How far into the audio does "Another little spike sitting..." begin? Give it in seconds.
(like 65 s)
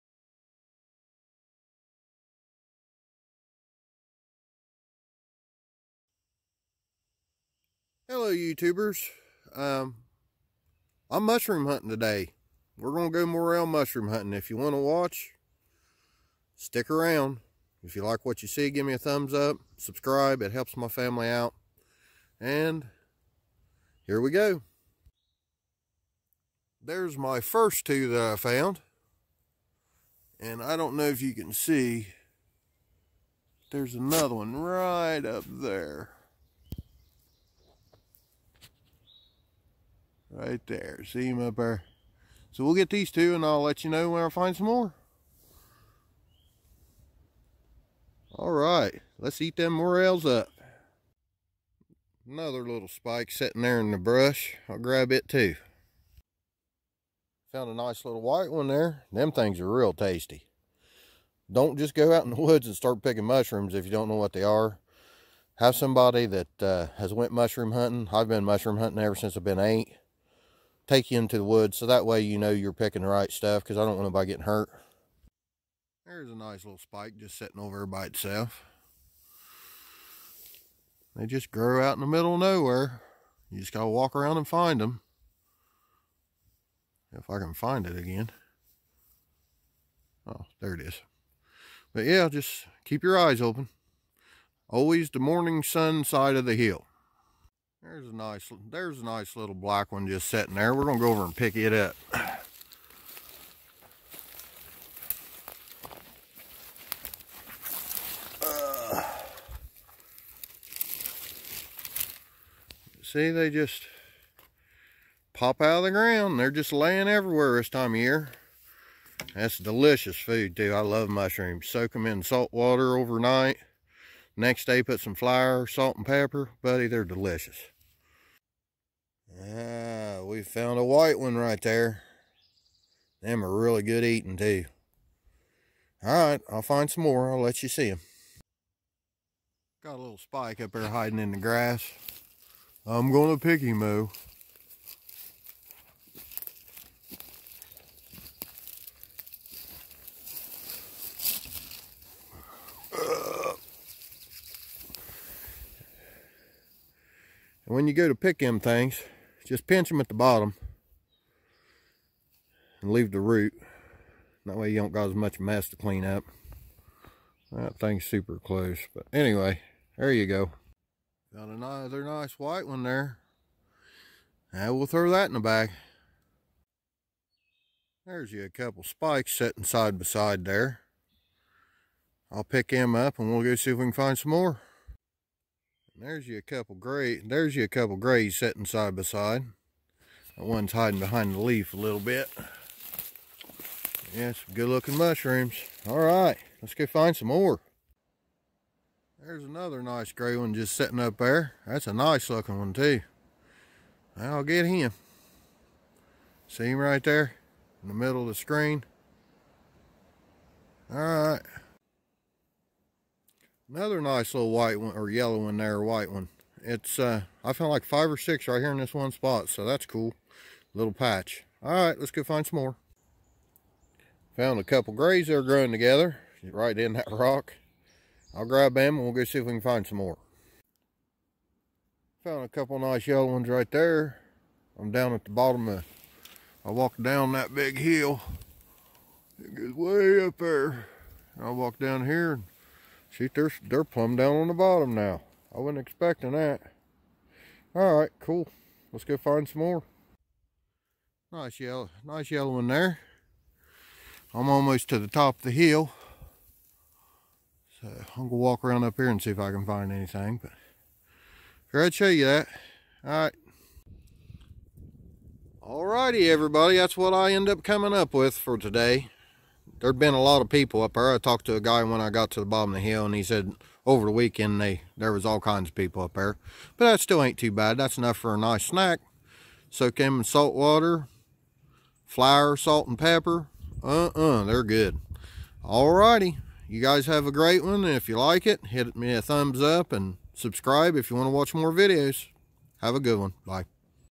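52 s.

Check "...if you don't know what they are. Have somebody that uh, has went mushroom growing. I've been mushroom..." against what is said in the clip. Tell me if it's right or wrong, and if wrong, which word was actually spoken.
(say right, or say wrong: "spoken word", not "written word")
wrong: "hunting", not "growing".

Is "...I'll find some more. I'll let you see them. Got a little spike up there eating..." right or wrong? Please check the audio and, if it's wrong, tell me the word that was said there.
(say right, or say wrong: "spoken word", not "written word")
wrong: "hiding", not "eating".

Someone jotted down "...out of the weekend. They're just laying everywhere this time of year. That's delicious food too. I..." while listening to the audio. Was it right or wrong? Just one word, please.
wrong.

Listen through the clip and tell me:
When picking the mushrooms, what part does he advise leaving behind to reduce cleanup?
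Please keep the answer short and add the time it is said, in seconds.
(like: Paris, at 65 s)
the root, at 163 s.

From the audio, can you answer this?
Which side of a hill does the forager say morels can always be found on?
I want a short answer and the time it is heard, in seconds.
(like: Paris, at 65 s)
morning sun side, at 95 s.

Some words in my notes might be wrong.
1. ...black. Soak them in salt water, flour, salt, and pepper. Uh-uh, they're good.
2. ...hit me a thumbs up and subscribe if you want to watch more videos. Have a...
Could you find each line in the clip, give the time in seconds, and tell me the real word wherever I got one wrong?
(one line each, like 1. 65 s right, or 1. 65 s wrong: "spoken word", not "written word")
1. 278 s wrong: "snack", not "black"
2. 288 s right.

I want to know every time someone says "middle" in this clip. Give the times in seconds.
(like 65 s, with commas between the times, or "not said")
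82 s, 207 s.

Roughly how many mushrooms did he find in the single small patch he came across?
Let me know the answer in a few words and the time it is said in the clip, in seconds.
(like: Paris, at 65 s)
5 or 6, at 217 s.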